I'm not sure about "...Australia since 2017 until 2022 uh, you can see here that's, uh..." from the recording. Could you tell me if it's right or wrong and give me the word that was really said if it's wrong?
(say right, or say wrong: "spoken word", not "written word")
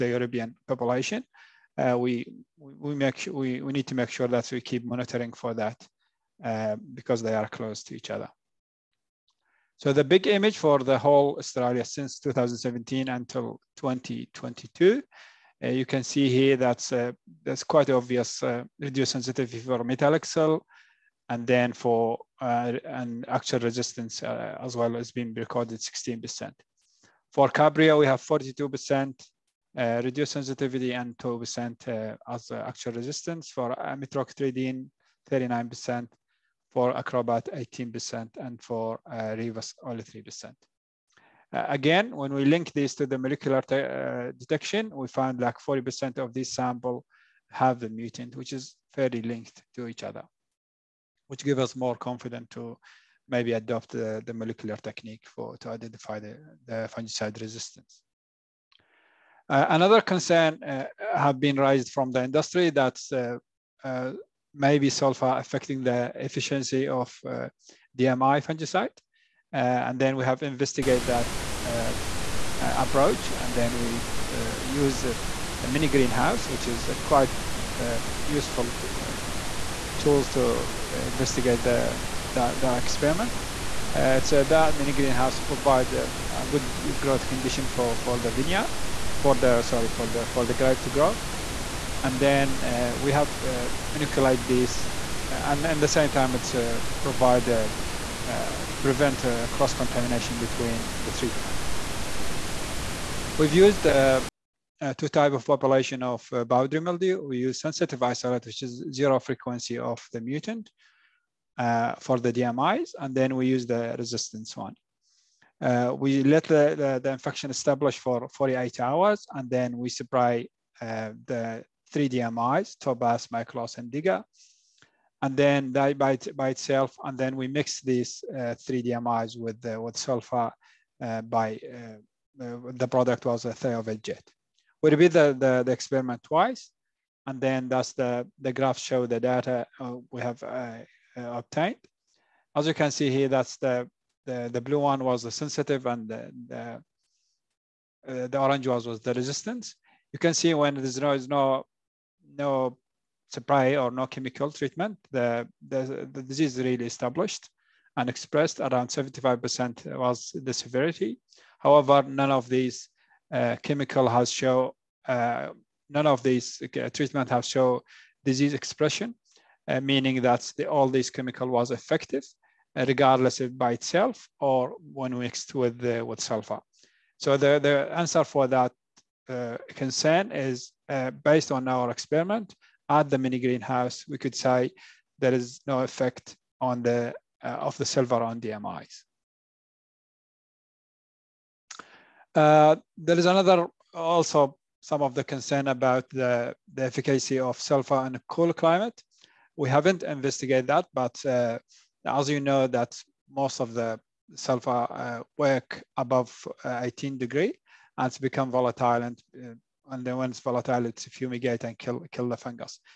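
right.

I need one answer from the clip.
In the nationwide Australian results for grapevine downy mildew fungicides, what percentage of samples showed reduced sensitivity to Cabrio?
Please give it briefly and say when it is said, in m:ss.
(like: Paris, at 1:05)
42%, at 0:28.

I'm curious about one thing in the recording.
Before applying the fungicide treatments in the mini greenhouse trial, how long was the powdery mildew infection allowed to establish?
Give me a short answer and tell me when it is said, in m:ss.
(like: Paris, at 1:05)
48 hours, at 1:58.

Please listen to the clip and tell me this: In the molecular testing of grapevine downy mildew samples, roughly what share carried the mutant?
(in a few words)
40%.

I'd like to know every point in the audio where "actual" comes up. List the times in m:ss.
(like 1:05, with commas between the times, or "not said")
0:23, 0:32.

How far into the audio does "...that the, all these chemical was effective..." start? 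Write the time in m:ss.
2:50.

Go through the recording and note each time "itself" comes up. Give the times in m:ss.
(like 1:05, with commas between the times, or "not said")
2:06, 2:53.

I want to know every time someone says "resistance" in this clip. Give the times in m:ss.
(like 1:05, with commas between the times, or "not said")
0:23, 0:32, 0:57, 1:53, 2:29.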